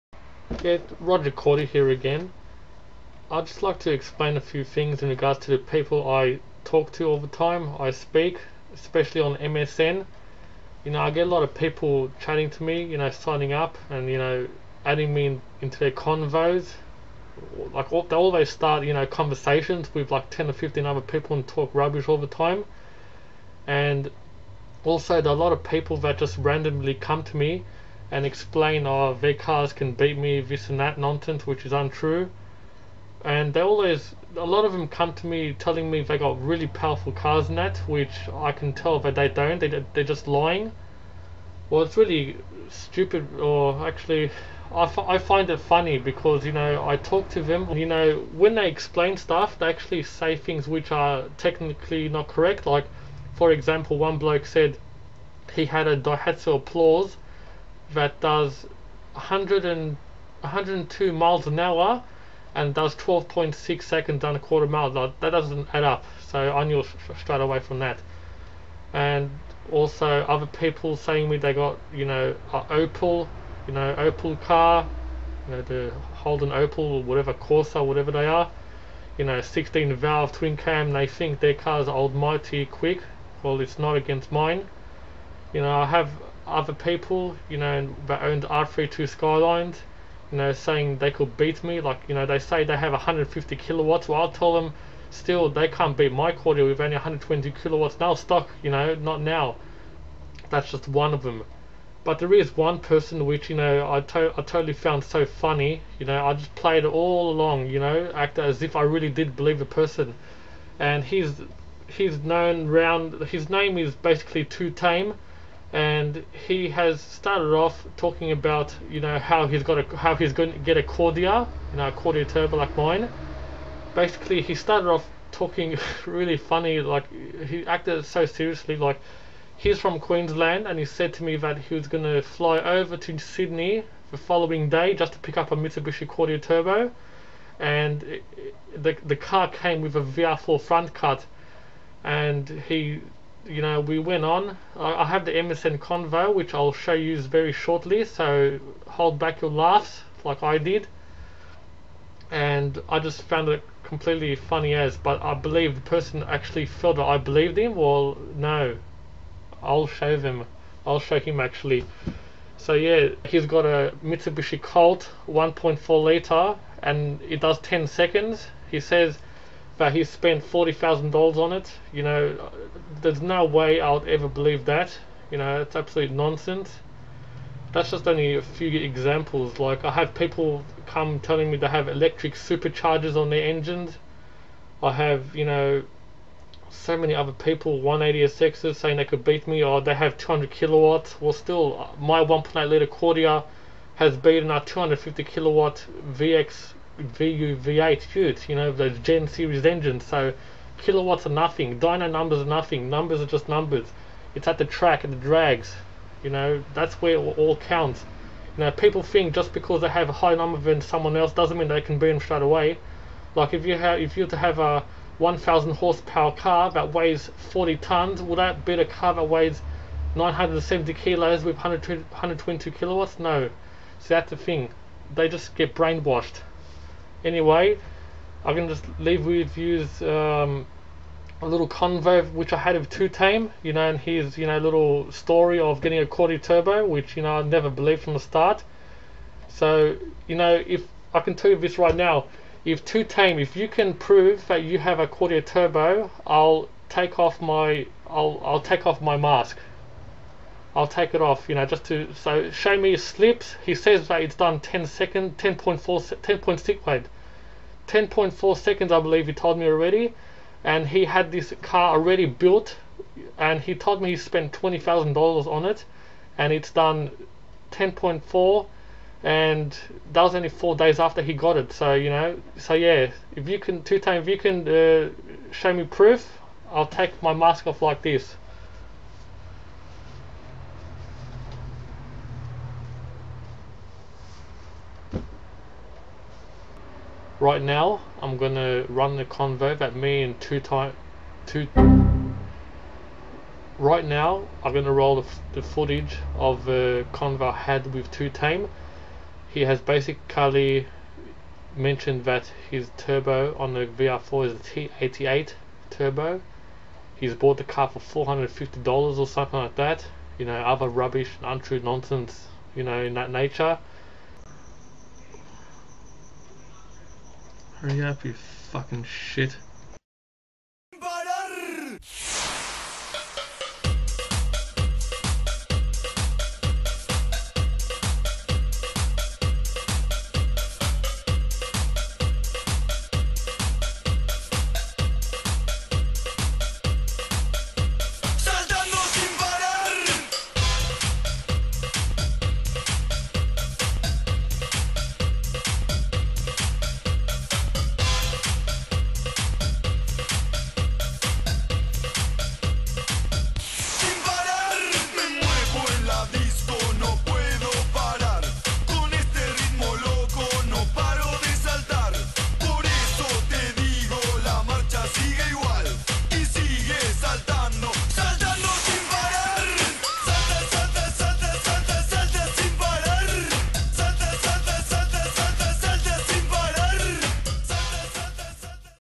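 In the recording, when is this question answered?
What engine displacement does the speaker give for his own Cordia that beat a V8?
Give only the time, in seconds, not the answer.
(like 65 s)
192 s.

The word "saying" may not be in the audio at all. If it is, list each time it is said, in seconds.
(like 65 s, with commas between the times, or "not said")
70 s, 90 s, 188 s.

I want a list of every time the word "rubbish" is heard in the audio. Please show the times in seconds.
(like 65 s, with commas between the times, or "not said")
21 s, 310 s.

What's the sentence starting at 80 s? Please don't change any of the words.
They think their cars are almighty quick.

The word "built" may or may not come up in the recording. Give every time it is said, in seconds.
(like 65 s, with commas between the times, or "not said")
262 s.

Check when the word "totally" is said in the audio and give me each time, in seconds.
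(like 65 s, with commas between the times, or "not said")
104 s.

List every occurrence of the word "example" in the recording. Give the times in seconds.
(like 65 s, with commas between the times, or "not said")
53 s, 178 s.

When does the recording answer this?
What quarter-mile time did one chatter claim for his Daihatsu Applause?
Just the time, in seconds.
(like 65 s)
62 s.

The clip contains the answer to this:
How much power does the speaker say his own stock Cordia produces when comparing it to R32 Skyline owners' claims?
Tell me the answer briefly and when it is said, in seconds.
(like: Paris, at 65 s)
120 kilowatts, at 96 s.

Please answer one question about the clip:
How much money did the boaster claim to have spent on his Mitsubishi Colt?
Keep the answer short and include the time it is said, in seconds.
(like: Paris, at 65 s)
$40,000, at 170 s.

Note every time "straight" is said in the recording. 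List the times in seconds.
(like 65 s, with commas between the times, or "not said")
67 s, 212 s.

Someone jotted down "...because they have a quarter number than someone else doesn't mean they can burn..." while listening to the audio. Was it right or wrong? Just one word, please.
wrong.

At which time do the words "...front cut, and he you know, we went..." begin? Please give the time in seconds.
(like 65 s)
140 s.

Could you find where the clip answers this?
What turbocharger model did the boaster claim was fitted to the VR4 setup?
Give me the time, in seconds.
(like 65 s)
304 s.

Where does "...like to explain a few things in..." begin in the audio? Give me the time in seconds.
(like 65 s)
3 s.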